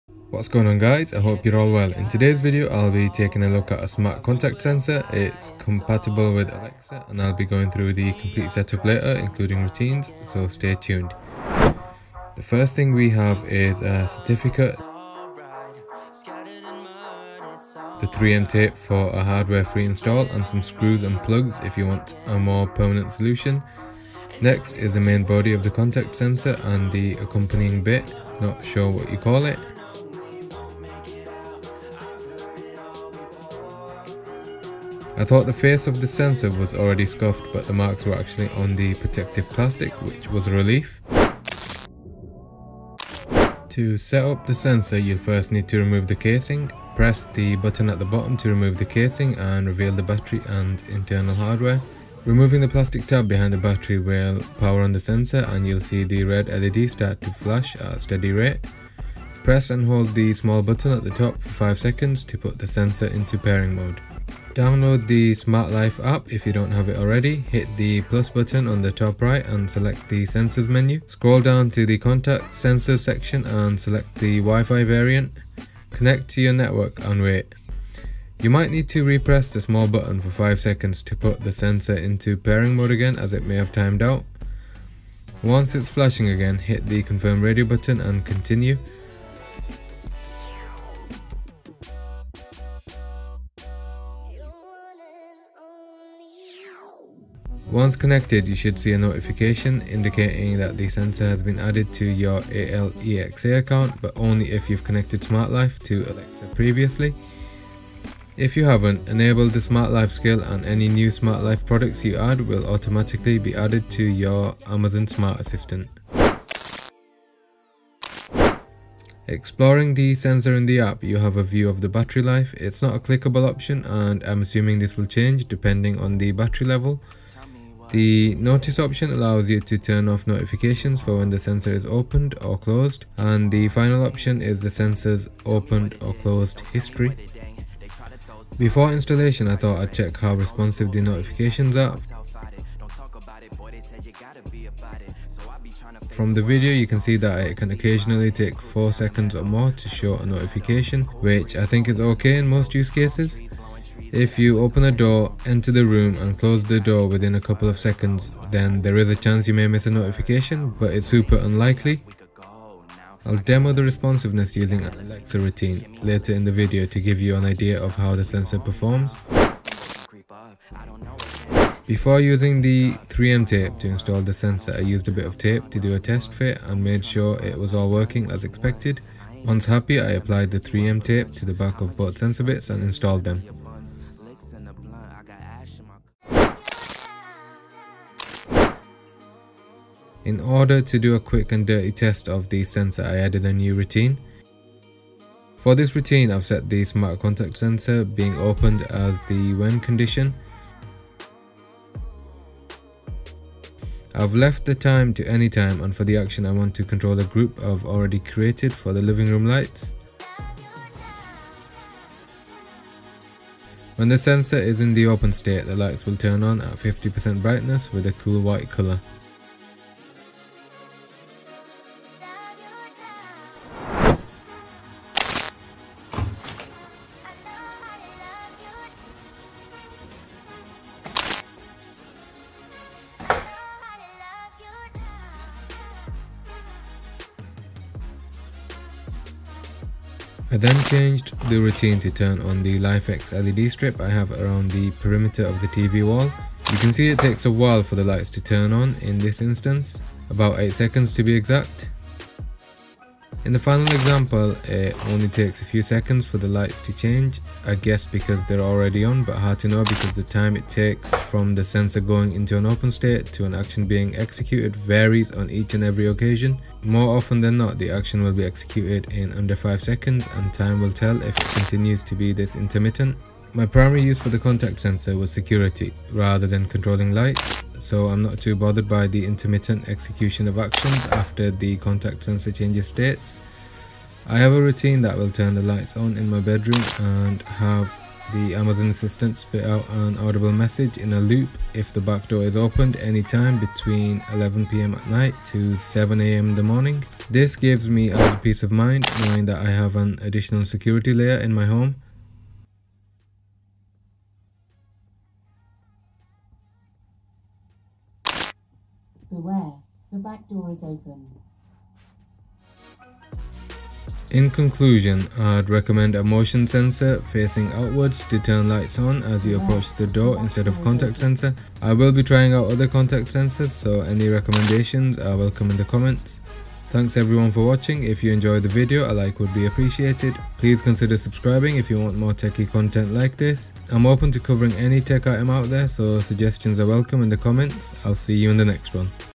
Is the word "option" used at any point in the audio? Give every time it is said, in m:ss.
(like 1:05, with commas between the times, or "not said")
2:03, 2:08, 2:14.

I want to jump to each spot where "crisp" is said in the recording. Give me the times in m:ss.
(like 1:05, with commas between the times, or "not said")
not said.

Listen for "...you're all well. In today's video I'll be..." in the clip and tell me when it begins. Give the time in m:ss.
0:01.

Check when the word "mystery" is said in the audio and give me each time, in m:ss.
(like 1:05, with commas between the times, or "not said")
not said.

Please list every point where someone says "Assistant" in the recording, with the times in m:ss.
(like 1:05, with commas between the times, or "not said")
1:55, 4:48.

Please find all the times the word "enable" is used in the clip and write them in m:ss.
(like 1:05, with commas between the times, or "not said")
1:49.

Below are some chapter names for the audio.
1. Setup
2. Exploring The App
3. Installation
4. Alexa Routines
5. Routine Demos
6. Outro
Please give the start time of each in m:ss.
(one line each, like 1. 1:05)
1. 0:41
2. 1:56
3. 2:50
4. 3:07
5. 3:44
6. 5:23.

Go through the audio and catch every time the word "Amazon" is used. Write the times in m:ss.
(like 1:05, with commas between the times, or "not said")
1:54, 4:48.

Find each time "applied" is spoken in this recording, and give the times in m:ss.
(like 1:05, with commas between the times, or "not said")
3:00.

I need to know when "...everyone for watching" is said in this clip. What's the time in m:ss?
5:27.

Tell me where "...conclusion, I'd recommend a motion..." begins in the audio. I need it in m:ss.
5:14.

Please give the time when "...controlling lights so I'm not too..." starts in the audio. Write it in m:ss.
4:36.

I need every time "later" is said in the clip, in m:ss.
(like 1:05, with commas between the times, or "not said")
0:08, 2:46.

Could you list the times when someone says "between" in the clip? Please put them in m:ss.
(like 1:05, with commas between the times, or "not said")
4:53.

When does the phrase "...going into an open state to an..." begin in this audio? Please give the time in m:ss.
4:22.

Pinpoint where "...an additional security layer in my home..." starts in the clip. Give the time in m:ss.
4:59.